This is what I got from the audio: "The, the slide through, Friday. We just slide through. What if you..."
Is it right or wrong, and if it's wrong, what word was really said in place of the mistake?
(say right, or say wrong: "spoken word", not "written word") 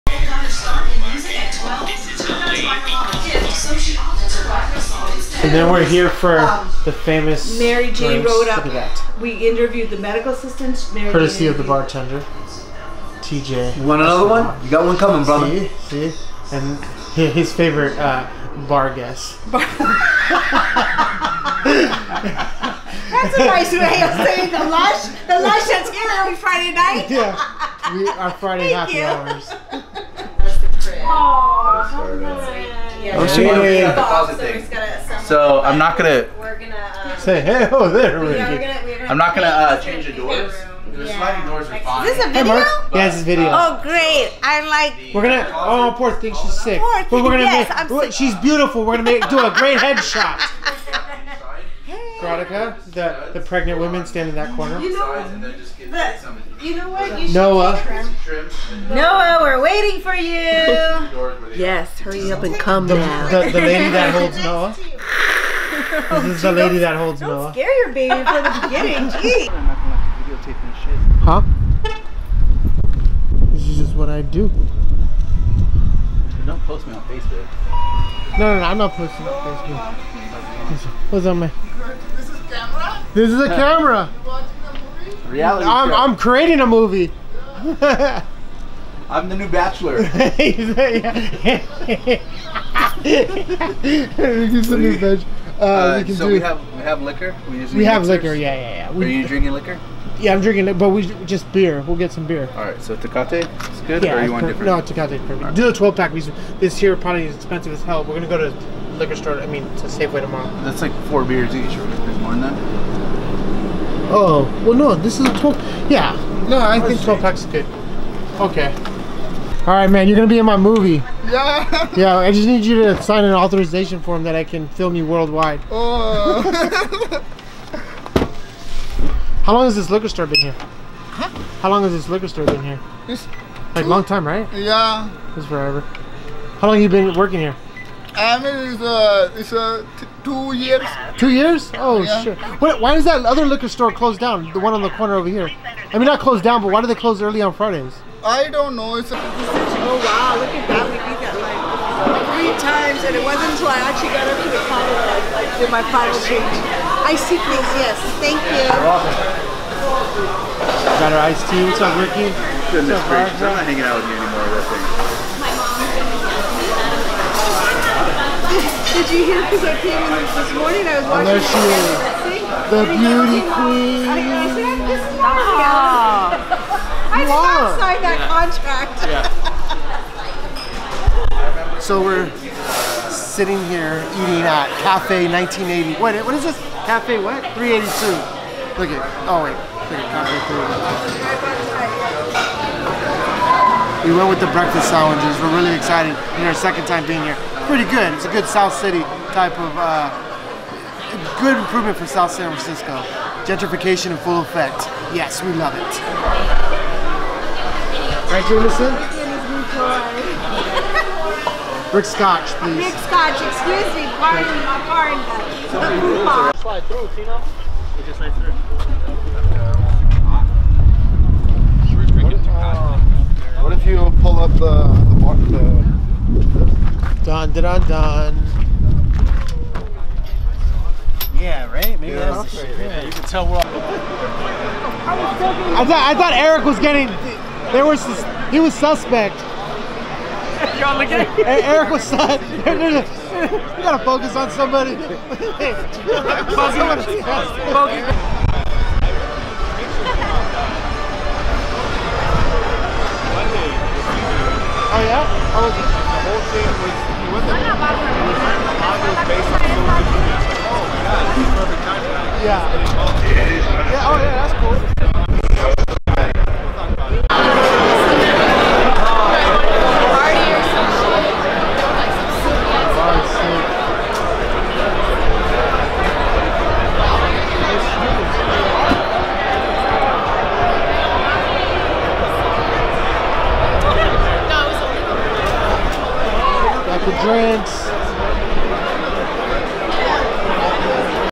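wrong: "Tina", not "Friday".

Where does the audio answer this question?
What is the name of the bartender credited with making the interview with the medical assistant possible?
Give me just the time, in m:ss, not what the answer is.
0:13.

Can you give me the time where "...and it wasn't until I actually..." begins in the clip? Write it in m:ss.
2:33.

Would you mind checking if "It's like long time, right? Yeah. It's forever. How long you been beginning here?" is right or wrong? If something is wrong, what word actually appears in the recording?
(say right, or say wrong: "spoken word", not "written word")
wrong: "working", not "beginning".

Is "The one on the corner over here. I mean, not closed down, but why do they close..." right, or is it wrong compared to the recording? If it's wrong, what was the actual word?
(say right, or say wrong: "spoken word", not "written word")
right.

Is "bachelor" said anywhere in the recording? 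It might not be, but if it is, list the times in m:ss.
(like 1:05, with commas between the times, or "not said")
1:29, 1:34.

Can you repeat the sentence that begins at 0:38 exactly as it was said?
we gonna, we gonna I'm not gonna uh, change the doors.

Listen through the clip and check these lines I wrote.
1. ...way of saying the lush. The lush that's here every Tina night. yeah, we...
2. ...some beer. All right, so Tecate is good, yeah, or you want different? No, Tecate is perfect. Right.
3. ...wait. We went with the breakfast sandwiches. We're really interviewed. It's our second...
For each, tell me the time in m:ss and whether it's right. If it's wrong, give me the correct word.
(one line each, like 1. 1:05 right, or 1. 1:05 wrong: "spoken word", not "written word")
1. 0:23 wrong: "Friday", not "Tina"
2. 1:42 right
3. 3:09 wrong: "excited", not "interviewed".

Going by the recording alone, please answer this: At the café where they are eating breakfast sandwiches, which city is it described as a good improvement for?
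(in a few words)
South San Francisco.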